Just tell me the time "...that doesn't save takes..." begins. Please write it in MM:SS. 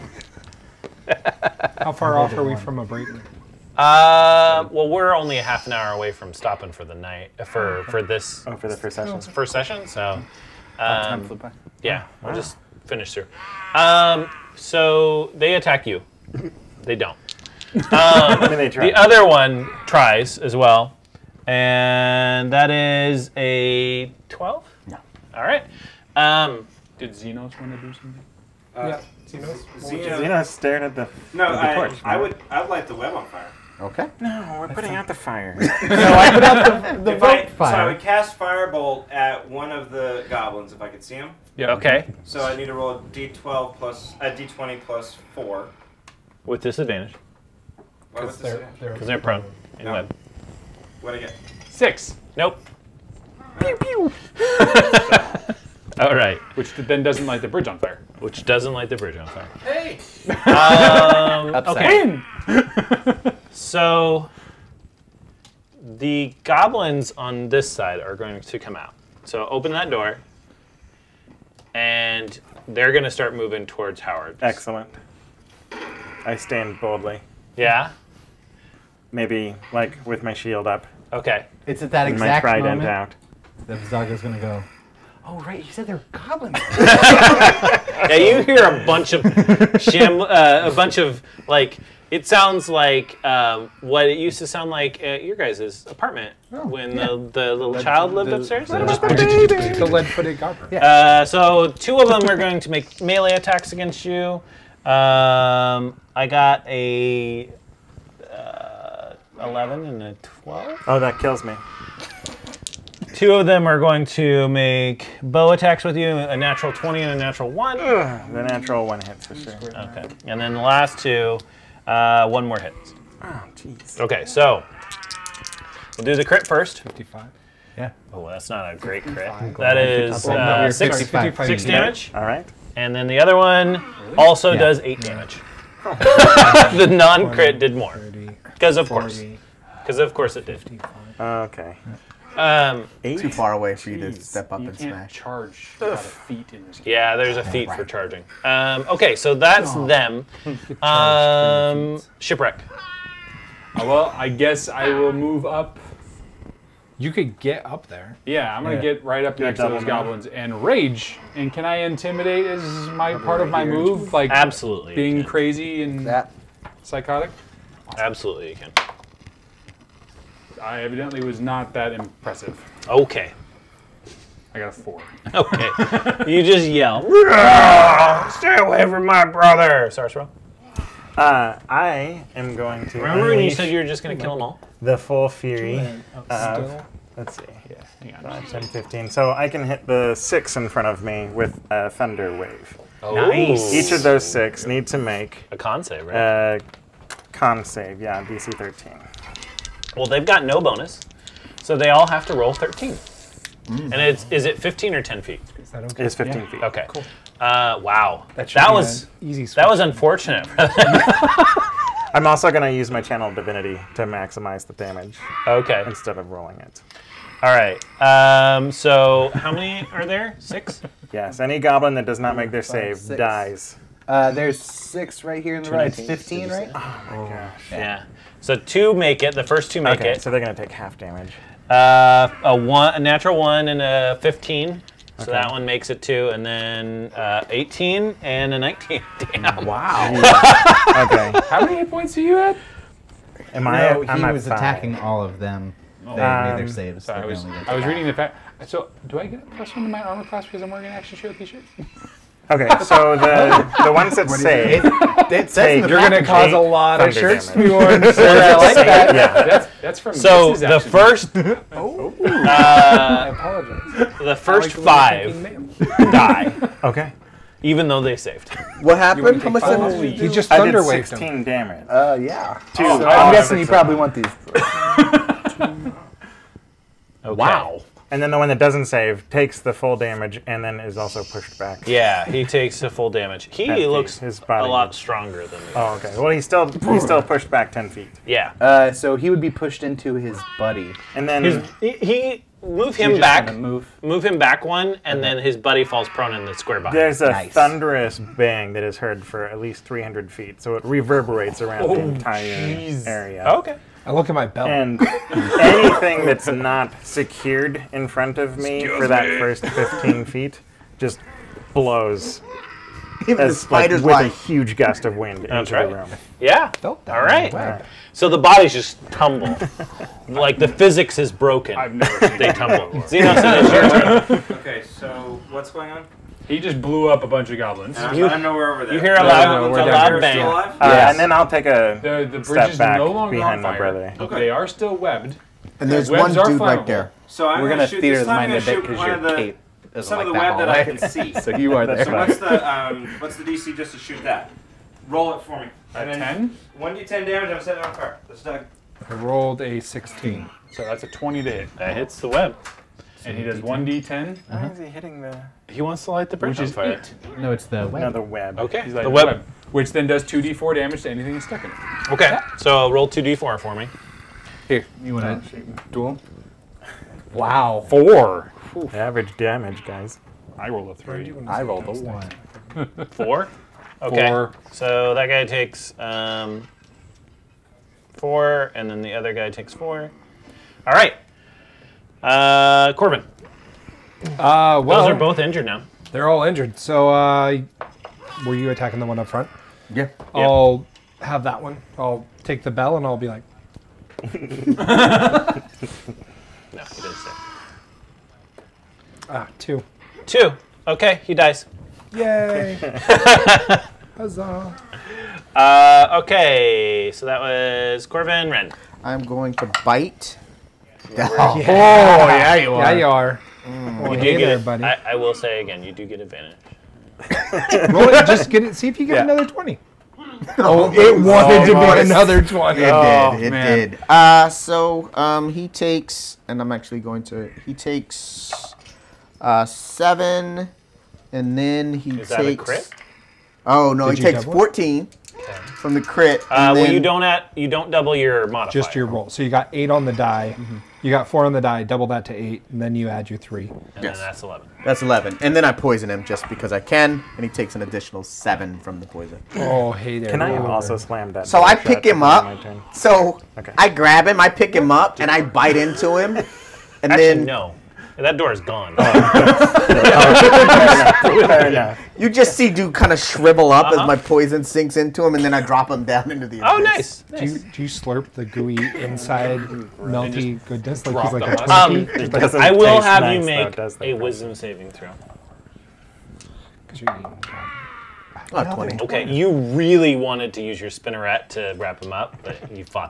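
04:38.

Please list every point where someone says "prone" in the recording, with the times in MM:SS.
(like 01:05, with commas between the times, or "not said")
00:49, 04:56.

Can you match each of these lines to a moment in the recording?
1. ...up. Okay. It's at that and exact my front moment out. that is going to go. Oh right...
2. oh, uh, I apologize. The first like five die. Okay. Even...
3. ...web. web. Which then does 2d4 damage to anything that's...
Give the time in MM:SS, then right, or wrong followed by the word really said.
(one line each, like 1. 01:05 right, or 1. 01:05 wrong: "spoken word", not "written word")
1. 01:20 wrong: "trident", not "front"
2. 04:21 right
3. 05:59 right.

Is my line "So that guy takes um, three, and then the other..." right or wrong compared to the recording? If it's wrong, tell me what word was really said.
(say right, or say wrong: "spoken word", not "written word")
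wrong: "four", not "three".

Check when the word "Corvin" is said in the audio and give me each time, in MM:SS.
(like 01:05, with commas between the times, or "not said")
06:22, 06:48.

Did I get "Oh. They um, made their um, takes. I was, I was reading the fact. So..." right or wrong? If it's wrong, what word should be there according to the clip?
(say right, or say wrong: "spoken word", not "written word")
wrong: "saves", not "takes".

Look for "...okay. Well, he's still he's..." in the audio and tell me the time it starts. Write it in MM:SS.
04:45.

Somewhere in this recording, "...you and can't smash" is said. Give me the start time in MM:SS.
02:24.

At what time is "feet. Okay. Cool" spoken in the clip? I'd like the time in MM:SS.
03:26.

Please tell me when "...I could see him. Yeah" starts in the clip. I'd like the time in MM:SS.
00:40.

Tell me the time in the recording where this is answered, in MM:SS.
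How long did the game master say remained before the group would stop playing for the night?
00:05.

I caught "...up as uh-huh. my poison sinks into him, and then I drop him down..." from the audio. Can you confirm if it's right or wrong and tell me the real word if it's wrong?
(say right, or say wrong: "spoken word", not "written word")
right.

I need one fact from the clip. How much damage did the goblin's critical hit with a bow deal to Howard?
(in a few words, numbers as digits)
6.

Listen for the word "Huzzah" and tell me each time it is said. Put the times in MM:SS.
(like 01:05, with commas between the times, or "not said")
06:44.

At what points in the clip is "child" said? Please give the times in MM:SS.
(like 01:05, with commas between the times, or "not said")
01:37.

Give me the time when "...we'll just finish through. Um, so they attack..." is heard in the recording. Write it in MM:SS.
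00:12.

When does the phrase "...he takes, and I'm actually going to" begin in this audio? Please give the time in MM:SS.
07:05.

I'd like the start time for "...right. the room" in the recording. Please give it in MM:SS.
05:15.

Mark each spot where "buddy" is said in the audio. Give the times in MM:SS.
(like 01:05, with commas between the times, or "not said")
04:50, 04:55, 06:54.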